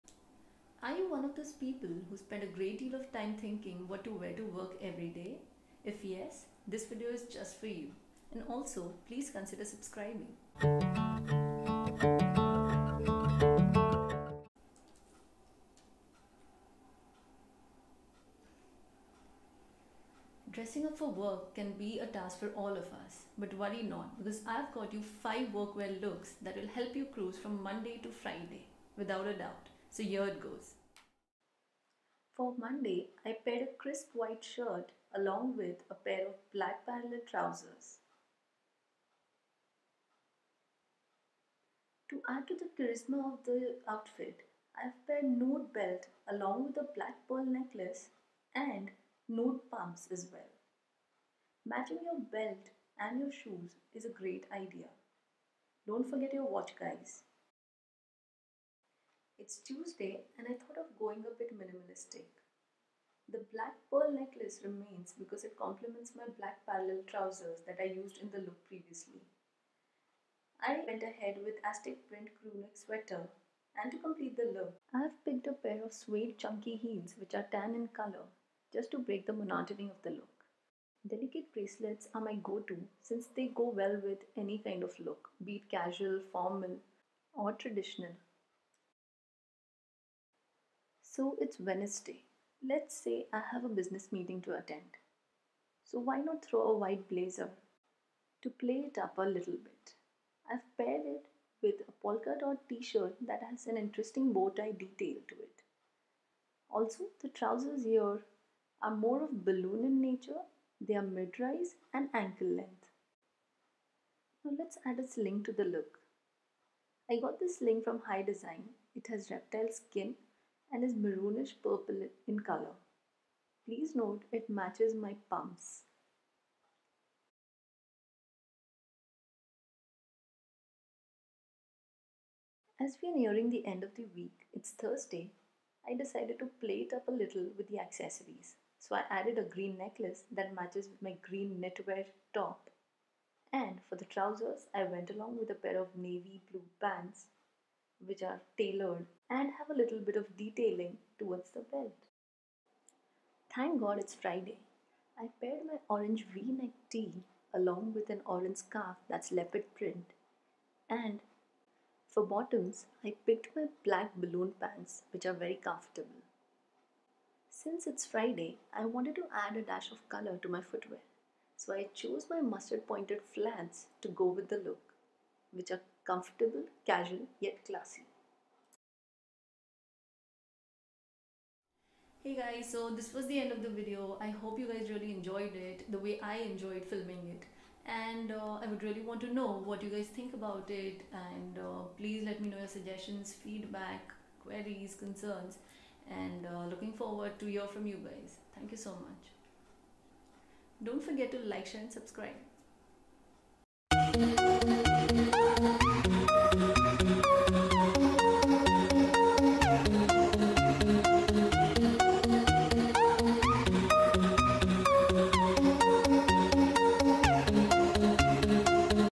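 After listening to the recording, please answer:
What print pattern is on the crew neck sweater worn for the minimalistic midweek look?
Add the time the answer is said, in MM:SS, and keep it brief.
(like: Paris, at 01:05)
Aztec print, at 01:11.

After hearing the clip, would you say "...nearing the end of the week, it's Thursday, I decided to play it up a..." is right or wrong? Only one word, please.
right.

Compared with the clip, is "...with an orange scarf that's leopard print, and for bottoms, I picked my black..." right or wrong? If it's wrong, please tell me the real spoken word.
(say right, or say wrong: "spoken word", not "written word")
right.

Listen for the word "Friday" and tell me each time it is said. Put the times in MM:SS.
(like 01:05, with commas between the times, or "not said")
00:28, 02:34, 02:48.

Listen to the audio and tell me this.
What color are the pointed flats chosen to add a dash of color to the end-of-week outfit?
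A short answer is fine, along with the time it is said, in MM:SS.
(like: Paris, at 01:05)
Mustard, at 02:52.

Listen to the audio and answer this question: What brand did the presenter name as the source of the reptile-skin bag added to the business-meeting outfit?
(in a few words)
Hidesign.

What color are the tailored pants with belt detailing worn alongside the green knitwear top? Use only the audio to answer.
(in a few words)
Navy blue.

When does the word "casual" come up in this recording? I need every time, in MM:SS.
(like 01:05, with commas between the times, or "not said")
01:25, 02:56.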